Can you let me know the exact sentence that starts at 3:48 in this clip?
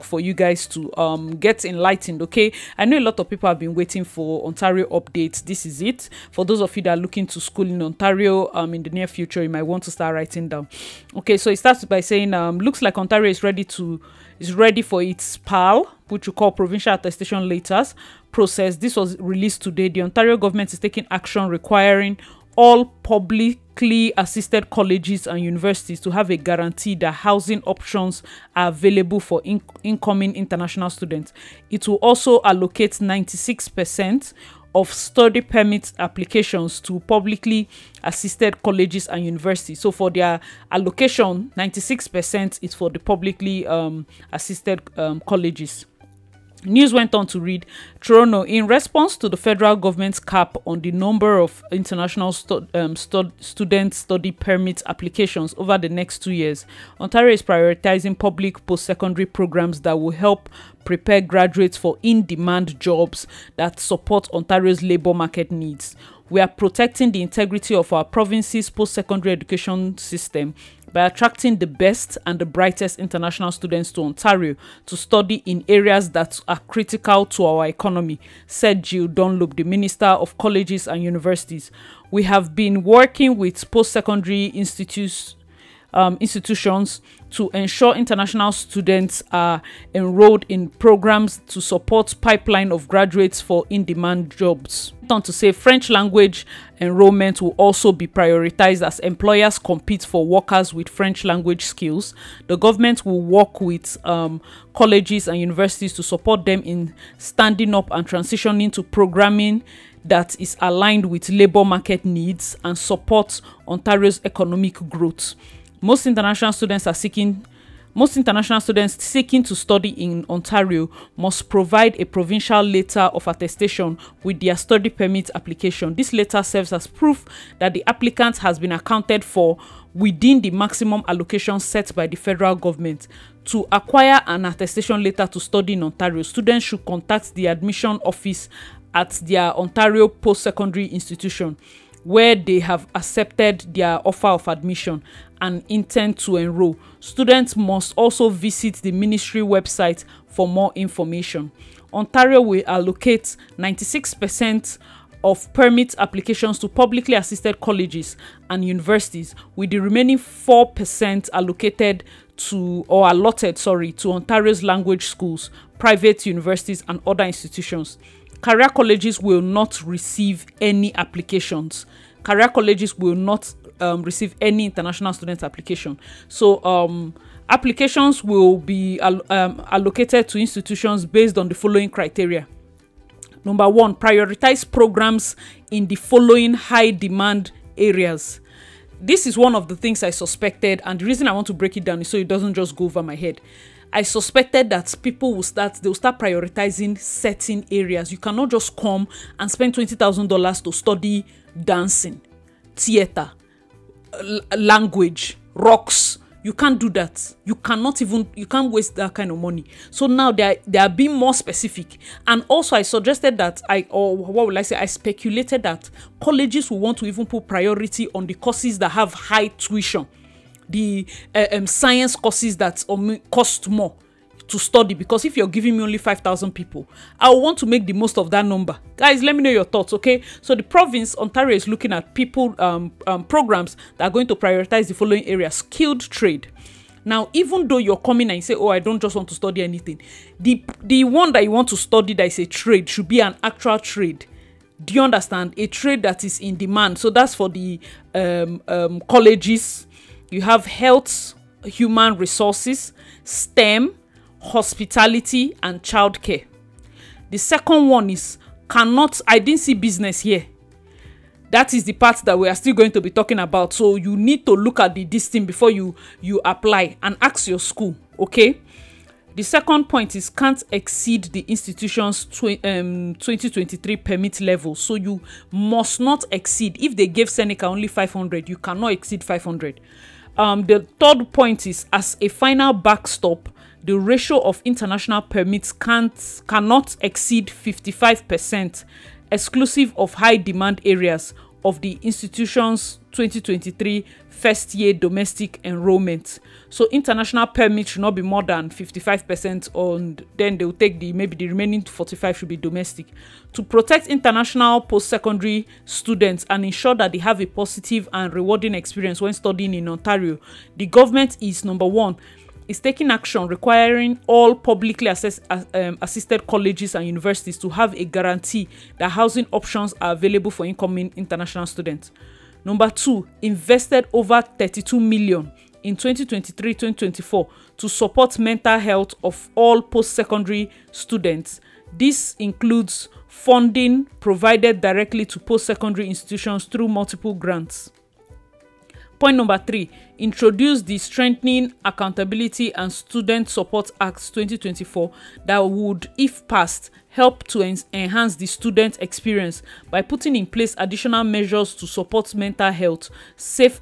Guys, let me know your thoughts, okay?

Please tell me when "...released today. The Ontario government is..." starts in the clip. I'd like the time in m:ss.
0:19.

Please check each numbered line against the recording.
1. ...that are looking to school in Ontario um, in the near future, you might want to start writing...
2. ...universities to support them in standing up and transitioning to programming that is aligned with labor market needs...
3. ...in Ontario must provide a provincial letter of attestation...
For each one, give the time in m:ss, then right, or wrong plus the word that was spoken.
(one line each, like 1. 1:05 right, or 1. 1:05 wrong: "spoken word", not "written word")
1. 0:06 right
2. 1:45 right
3. 1:59 right.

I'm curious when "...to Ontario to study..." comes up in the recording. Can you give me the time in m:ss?
1:13.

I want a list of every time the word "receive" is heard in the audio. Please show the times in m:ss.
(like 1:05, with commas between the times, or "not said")
2:49, 2:54.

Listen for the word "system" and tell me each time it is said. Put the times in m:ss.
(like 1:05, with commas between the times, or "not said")
1:09.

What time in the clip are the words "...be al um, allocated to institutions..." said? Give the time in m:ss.
2:58.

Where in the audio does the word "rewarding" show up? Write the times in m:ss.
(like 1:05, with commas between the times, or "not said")
5:08.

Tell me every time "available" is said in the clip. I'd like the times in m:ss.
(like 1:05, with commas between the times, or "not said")
0:28, 5:20.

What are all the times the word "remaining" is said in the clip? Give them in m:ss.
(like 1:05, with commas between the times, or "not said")
2:39, 5:01.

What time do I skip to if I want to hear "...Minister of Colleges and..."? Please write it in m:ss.
1:19.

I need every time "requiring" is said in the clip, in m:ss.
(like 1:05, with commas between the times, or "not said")
0:21, 5:13.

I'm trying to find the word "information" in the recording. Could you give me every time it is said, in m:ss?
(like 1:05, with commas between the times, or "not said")
2:30.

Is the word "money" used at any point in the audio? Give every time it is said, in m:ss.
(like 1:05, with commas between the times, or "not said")
3:29.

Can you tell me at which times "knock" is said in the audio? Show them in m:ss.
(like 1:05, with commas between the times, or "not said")
not said.